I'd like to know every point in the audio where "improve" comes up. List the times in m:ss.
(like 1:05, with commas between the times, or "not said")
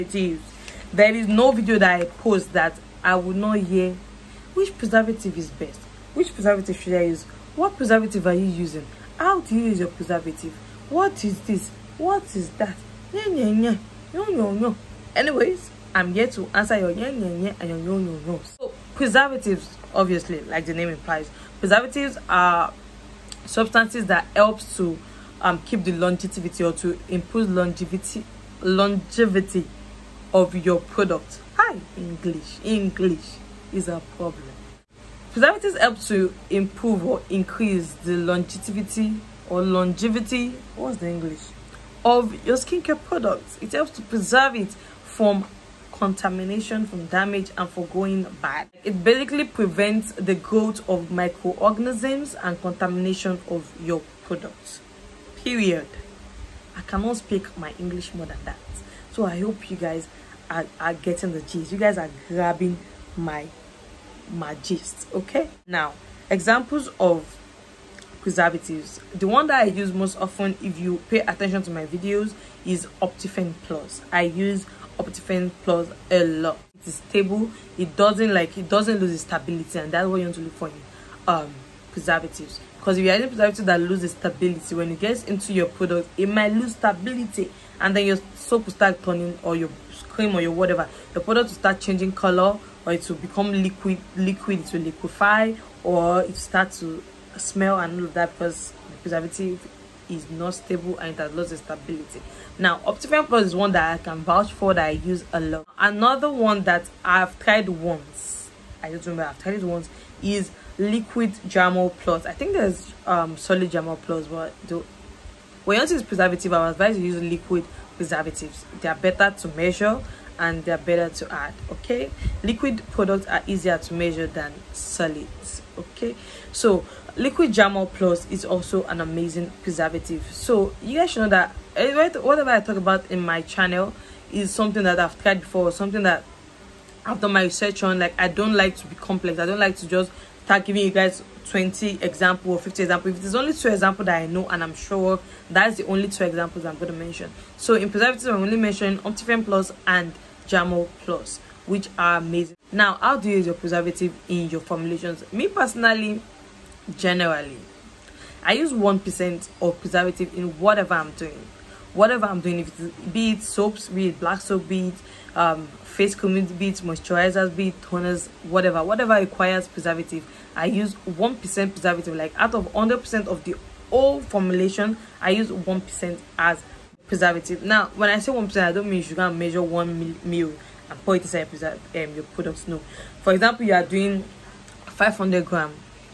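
0:27, 0:36.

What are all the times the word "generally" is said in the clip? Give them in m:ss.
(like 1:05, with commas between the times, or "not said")
2:36.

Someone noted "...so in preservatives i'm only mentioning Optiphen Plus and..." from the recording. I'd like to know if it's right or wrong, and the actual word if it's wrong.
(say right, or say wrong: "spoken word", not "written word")
right.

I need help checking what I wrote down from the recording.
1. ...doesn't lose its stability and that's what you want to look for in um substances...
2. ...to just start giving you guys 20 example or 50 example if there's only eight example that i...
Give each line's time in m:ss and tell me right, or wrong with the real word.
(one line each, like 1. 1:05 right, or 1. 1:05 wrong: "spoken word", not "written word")
1. 1:18 wrong: "preservatives", not "substances"
2. 2:19 wrong: "two", not "eight".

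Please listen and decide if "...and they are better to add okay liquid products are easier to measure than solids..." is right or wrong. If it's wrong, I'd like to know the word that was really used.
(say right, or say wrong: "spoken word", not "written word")
right.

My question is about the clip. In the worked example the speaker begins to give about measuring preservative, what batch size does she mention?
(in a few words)
500 grams.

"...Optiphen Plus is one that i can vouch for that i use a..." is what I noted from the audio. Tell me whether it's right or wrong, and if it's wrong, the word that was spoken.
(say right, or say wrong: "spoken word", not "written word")
right.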